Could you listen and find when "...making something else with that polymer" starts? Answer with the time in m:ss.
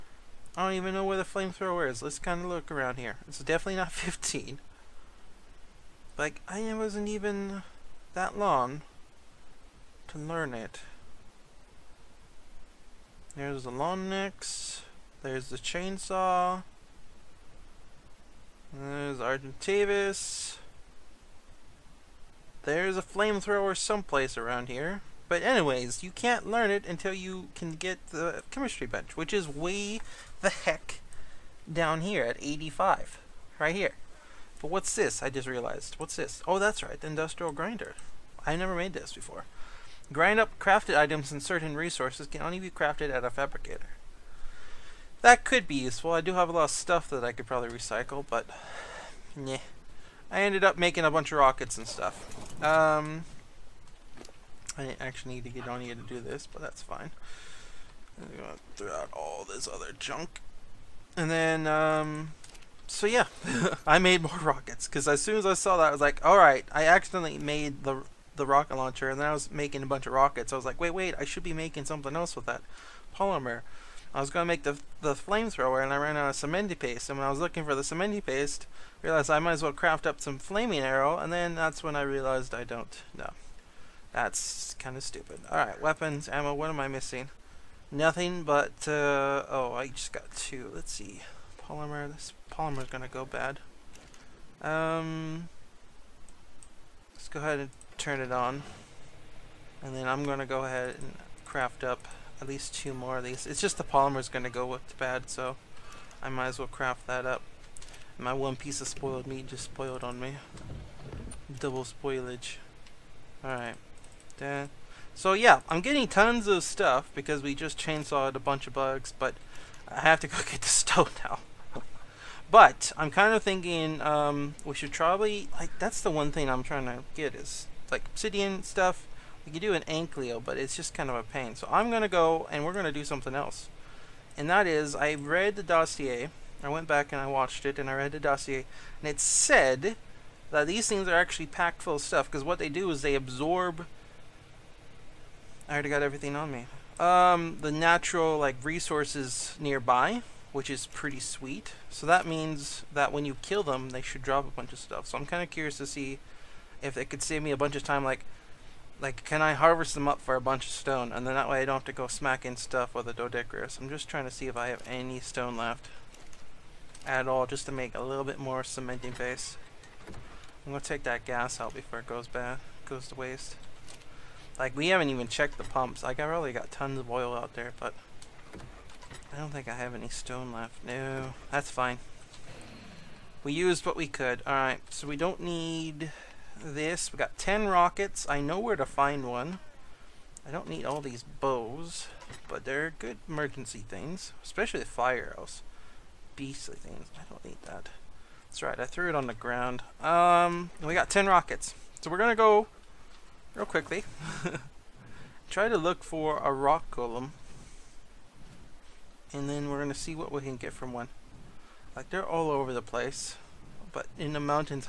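1:11.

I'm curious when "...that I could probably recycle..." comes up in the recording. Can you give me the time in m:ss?
0:47.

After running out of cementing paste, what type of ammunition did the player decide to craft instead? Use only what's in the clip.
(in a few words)
Flaming arrow.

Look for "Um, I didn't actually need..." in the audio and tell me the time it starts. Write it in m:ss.
0:52.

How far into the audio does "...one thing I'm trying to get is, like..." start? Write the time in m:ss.
2:06.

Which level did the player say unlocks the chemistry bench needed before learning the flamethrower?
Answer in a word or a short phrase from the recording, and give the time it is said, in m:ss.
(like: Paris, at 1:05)
85, at 0:32.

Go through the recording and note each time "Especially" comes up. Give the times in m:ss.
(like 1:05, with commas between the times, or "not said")
3:14.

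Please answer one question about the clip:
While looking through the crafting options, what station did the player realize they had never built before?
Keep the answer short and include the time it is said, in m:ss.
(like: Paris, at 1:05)
Industrial grinder, at 0:37.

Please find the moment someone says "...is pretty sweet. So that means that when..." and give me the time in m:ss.
2:30.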